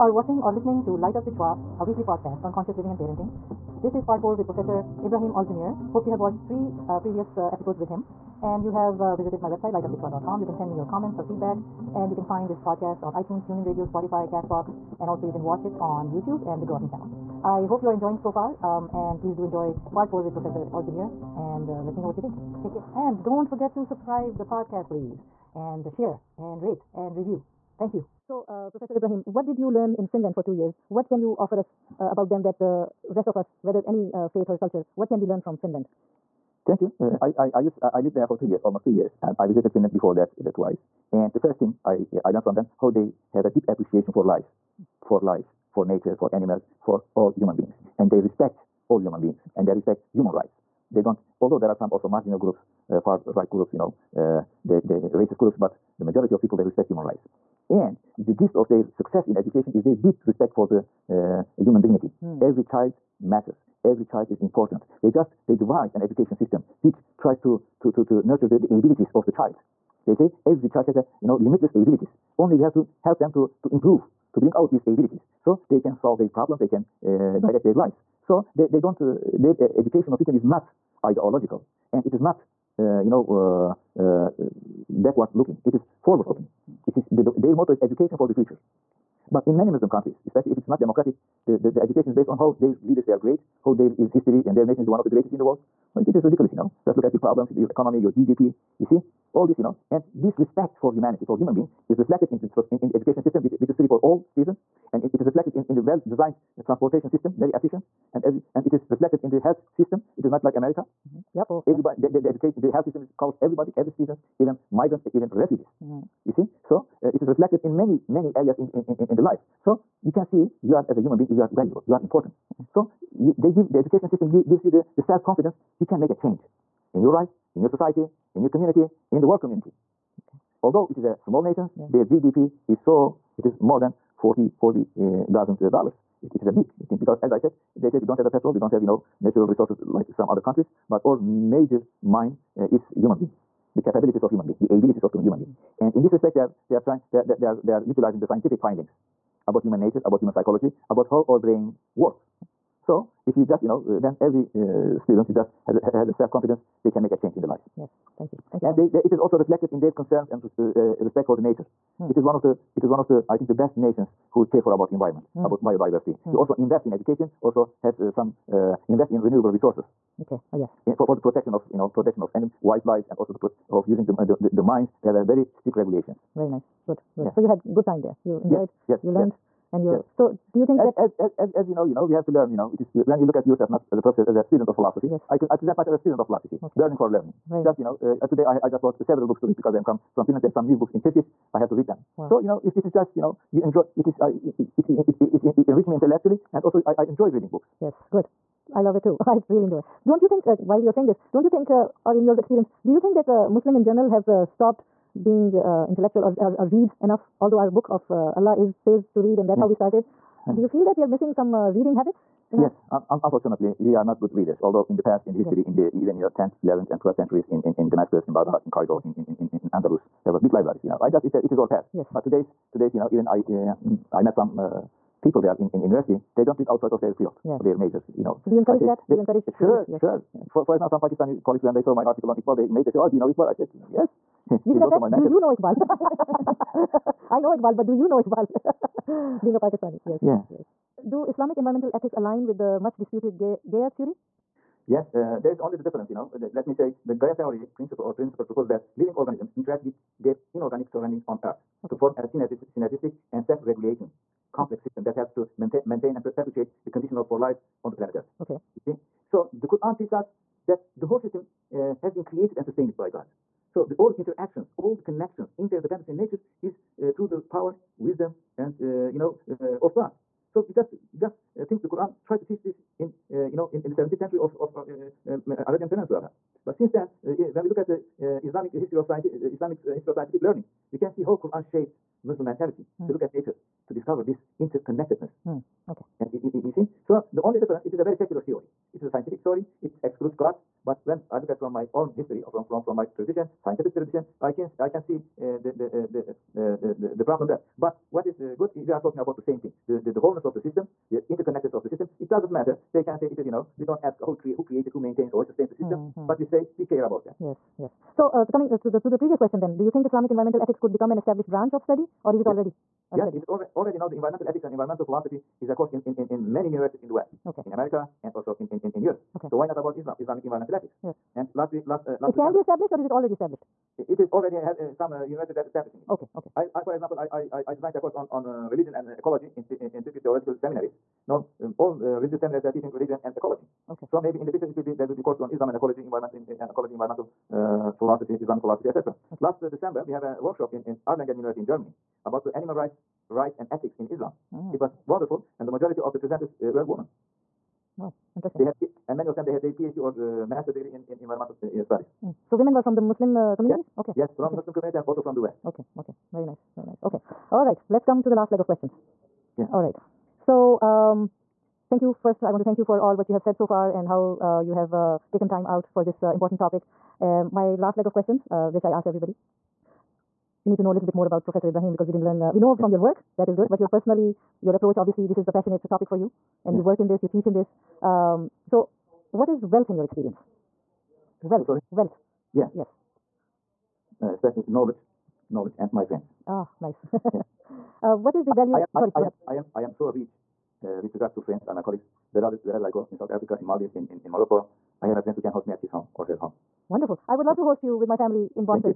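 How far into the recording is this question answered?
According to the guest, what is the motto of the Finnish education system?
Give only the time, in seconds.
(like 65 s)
87 s.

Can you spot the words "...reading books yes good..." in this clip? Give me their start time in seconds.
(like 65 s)
197 s.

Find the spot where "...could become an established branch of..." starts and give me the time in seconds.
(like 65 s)
310 s.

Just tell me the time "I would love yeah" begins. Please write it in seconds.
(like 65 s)
397 s.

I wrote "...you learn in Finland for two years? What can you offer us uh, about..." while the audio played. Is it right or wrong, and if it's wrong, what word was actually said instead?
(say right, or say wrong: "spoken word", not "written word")
right.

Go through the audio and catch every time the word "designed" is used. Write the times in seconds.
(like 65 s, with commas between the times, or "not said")
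105 s, 327 s.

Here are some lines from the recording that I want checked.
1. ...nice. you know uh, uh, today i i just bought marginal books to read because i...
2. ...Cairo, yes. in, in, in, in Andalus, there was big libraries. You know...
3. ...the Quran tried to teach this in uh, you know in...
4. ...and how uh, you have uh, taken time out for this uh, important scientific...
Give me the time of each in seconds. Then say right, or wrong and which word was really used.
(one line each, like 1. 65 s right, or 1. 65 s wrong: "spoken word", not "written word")
1. 187 s wrong: "several", not "marginal"
2. 218 s right
3. 271 s right
4. 363 s wrong: "topic", not "scientific".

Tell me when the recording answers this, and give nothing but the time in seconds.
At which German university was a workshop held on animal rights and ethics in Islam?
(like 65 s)
341 s.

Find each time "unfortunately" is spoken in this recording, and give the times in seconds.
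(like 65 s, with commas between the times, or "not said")
213 s.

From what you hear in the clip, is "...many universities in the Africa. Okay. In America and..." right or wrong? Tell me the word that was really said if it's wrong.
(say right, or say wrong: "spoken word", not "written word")
wrong: "West", not "Africa".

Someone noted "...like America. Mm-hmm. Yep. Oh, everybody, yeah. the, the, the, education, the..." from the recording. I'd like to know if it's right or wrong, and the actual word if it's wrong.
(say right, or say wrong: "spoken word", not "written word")
right.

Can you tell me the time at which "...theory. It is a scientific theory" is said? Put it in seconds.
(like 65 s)
288 s.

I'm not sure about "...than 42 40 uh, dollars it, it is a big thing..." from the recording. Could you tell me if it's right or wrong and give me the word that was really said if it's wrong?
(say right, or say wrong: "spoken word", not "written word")
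wrong: "40", not "42".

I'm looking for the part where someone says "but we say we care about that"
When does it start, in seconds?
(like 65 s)
306 s.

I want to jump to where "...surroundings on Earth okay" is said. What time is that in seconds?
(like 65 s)
250 s.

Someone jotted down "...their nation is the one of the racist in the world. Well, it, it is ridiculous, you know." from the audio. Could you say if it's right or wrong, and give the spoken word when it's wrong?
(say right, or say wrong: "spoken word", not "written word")
wrong: "greatest", not "racist".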